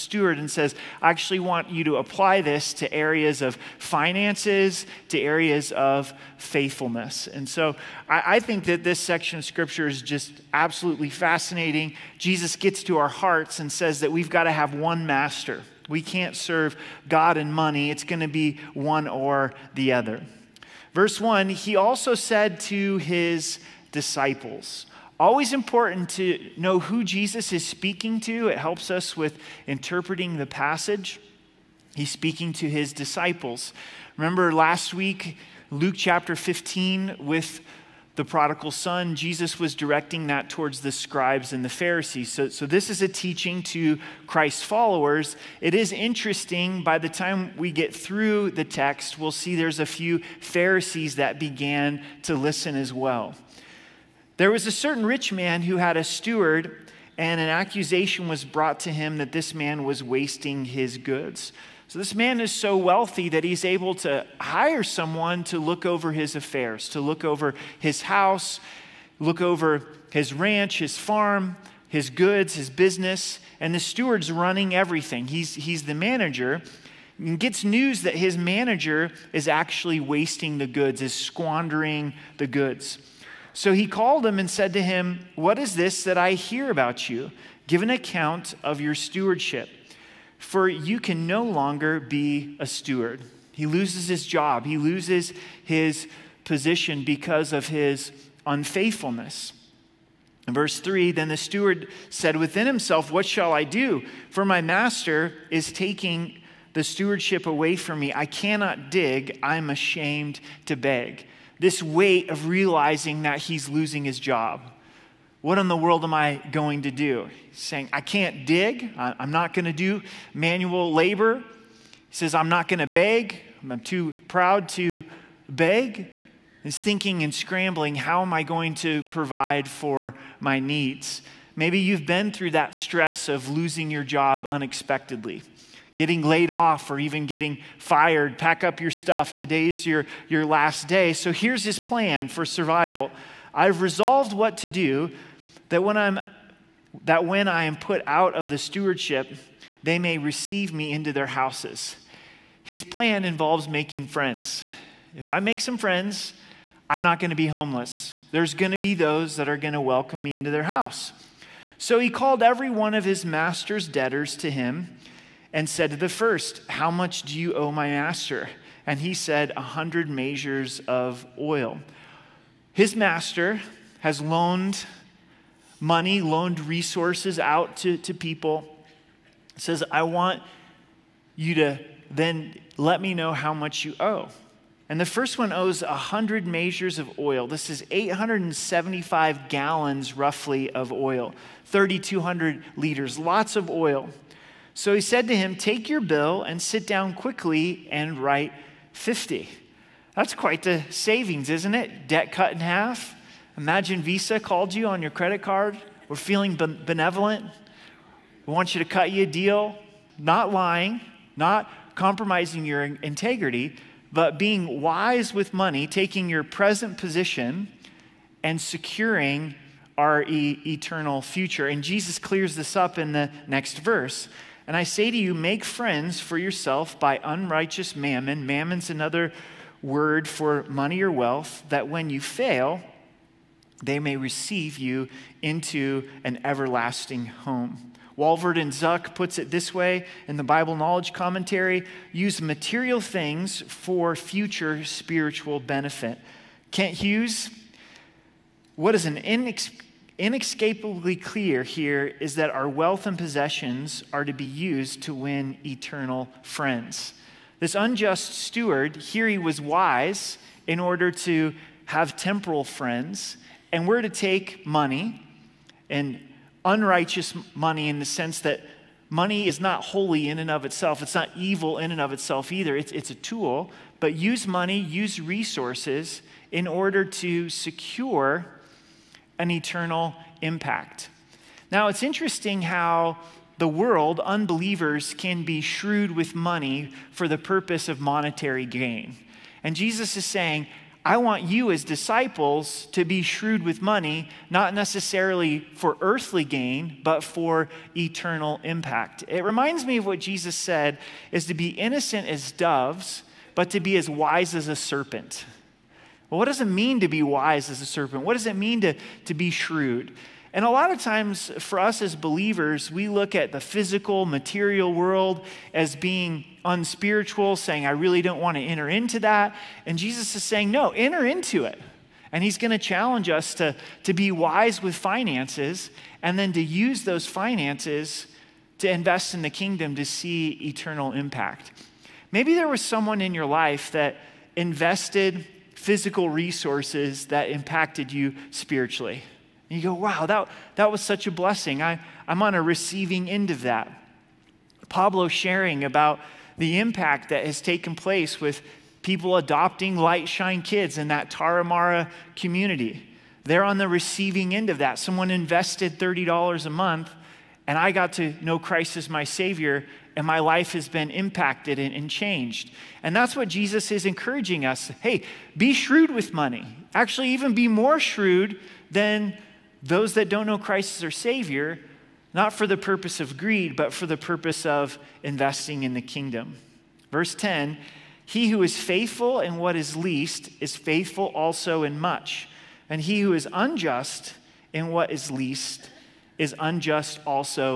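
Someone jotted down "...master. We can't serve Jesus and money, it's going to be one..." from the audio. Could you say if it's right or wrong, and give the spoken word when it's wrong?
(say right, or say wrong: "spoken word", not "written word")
wrong: "God", not "Jesus".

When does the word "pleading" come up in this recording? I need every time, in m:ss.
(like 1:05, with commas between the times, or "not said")
not said.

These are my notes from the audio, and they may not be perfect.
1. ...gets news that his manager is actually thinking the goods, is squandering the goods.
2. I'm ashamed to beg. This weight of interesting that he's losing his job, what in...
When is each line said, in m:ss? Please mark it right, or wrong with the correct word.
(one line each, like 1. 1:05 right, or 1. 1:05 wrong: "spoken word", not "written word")
1. 1:17 wrong: "wasting", not "thinking"
2. 1:49 wrong: "realizing", not "interesting".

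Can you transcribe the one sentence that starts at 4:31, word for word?
It's not evil in and of itself either.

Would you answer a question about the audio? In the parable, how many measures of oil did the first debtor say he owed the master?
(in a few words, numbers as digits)
100.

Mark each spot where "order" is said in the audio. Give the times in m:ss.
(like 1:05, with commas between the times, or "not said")
4:20, 4:36.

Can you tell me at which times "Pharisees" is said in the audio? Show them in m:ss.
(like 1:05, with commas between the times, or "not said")
0:41, 0:50.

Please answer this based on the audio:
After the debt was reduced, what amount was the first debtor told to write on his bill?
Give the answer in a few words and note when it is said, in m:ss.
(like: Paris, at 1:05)
50, at 3:18.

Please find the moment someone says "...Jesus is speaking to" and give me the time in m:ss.
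0:27.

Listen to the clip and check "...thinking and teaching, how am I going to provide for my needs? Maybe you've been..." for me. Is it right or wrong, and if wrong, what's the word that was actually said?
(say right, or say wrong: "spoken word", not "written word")
wrong: "scrambling", not "teaching".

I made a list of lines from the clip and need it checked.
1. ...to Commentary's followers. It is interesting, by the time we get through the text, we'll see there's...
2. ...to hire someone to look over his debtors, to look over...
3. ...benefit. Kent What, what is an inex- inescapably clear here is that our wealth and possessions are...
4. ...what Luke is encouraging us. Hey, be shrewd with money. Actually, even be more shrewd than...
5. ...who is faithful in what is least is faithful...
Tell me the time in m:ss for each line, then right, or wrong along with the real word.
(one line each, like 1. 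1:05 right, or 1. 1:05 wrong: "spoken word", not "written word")
1. 0:43 wrong: "Christ", not "Commentary"
2. 1:03 wrong: "affairs", not "debtors"
3. 4:05 wrong: "Hughes", not "What"
4. 6:03 wrong: "Jesus", not "Luke"
5. 6:18 right.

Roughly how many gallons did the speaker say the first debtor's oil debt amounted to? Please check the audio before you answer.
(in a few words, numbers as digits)
875 gallons.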